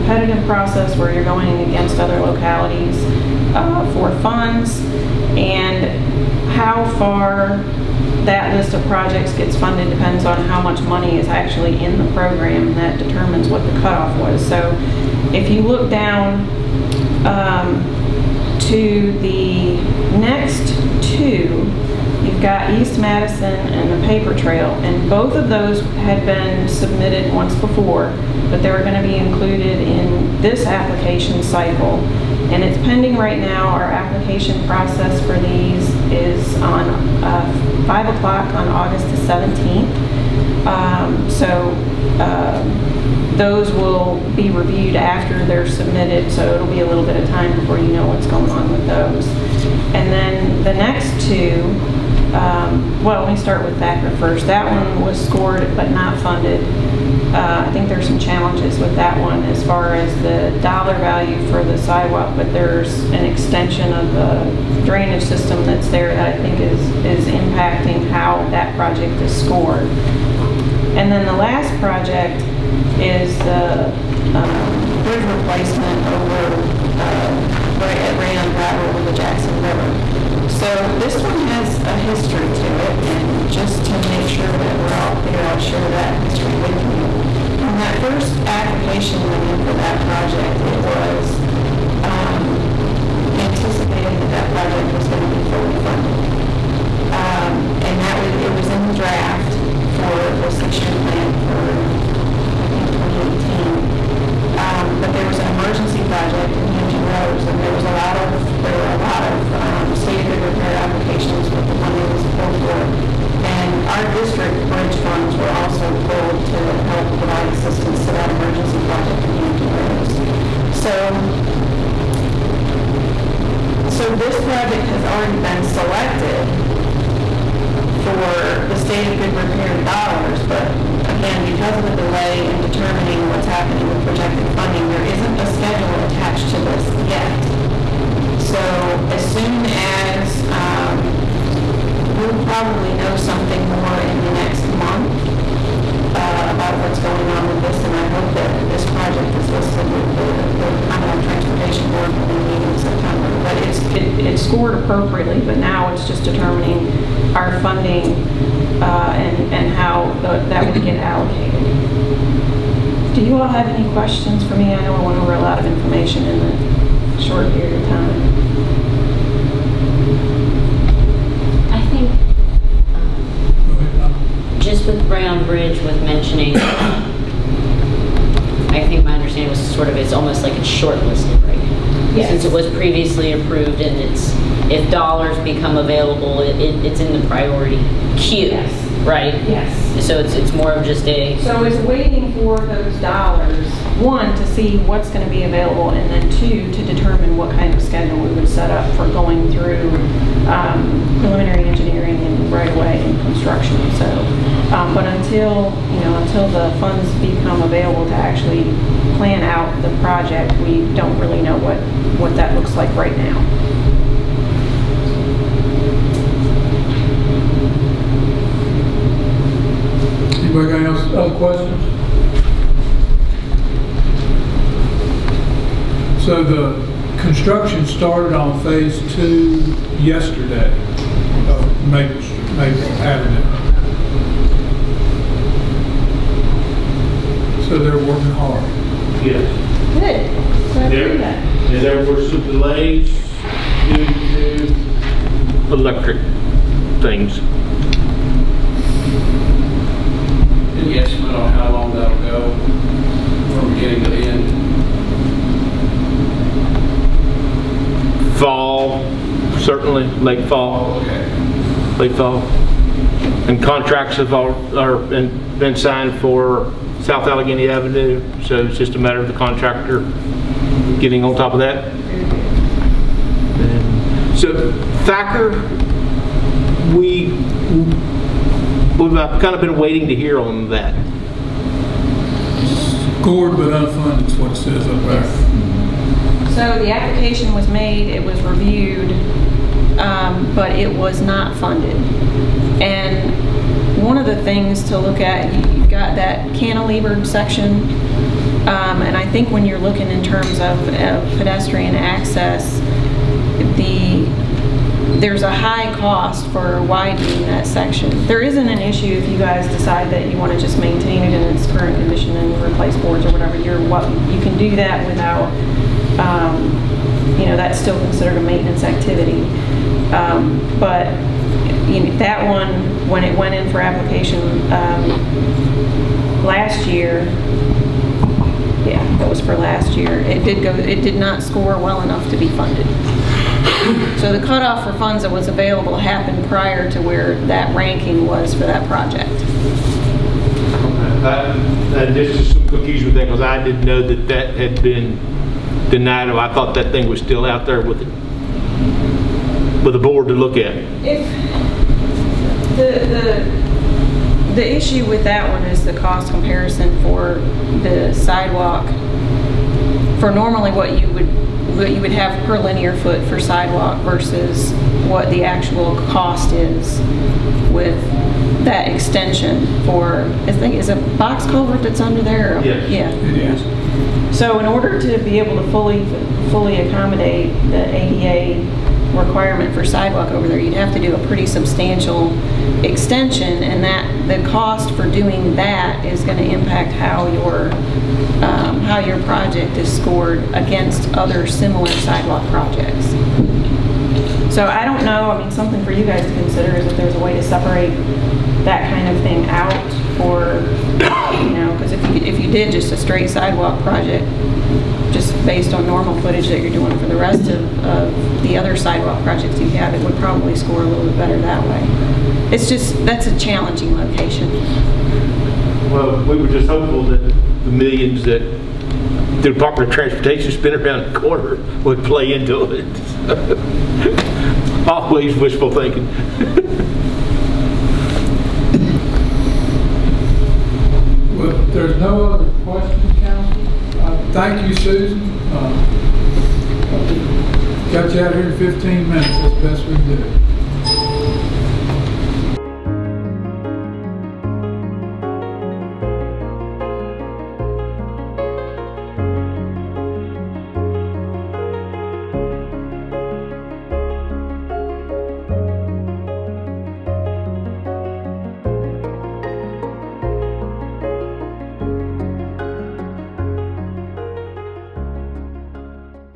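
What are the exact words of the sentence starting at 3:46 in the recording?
So the construction started on phase two yesterday of Maple, Maple Avenue.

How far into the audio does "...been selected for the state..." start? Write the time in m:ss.
2:05.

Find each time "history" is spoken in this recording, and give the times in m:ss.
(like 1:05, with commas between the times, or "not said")
1:21, 1:26.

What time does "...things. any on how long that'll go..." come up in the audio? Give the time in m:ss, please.
4:07.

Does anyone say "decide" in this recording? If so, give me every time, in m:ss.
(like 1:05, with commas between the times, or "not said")
5:09.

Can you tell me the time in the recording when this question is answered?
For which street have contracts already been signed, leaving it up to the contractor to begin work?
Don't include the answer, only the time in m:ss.
4:27.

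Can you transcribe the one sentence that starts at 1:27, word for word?
When that first application went in for that project, it was um, anticipated that that project was going to be fully funded.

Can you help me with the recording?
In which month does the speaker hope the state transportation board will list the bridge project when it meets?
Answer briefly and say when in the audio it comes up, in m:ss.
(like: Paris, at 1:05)
September, at 2:32.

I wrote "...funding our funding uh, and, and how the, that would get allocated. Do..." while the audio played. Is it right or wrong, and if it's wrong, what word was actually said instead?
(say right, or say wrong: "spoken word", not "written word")
wrong: "determining", not "funding".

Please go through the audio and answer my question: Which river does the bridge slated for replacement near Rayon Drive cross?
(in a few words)
Jackson River.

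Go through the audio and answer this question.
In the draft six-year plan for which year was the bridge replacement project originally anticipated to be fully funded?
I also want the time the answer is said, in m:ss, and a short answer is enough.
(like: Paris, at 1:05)
2018, at 1:43.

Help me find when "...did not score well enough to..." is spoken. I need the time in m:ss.
5:31.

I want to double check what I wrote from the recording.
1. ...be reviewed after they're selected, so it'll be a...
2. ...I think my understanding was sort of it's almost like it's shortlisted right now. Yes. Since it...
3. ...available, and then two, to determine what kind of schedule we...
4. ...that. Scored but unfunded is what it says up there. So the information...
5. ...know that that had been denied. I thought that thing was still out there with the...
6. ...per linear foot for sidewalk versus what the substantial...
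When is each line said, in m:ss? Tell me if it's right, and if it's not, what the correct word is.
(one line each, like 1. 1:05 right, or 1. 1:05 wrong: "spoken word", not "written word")
1. 0:44 wrong: "submitted", not "selected"
2. 2:56 right
3. 3:15 right
4. 4:40 wrong: "application", not "information"
5. 5:43 right
6. 6:02 wrong: "actual", not "substantial".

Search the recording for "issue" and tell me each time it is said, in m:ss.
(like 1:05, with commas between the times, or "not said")
5:08, 5:54.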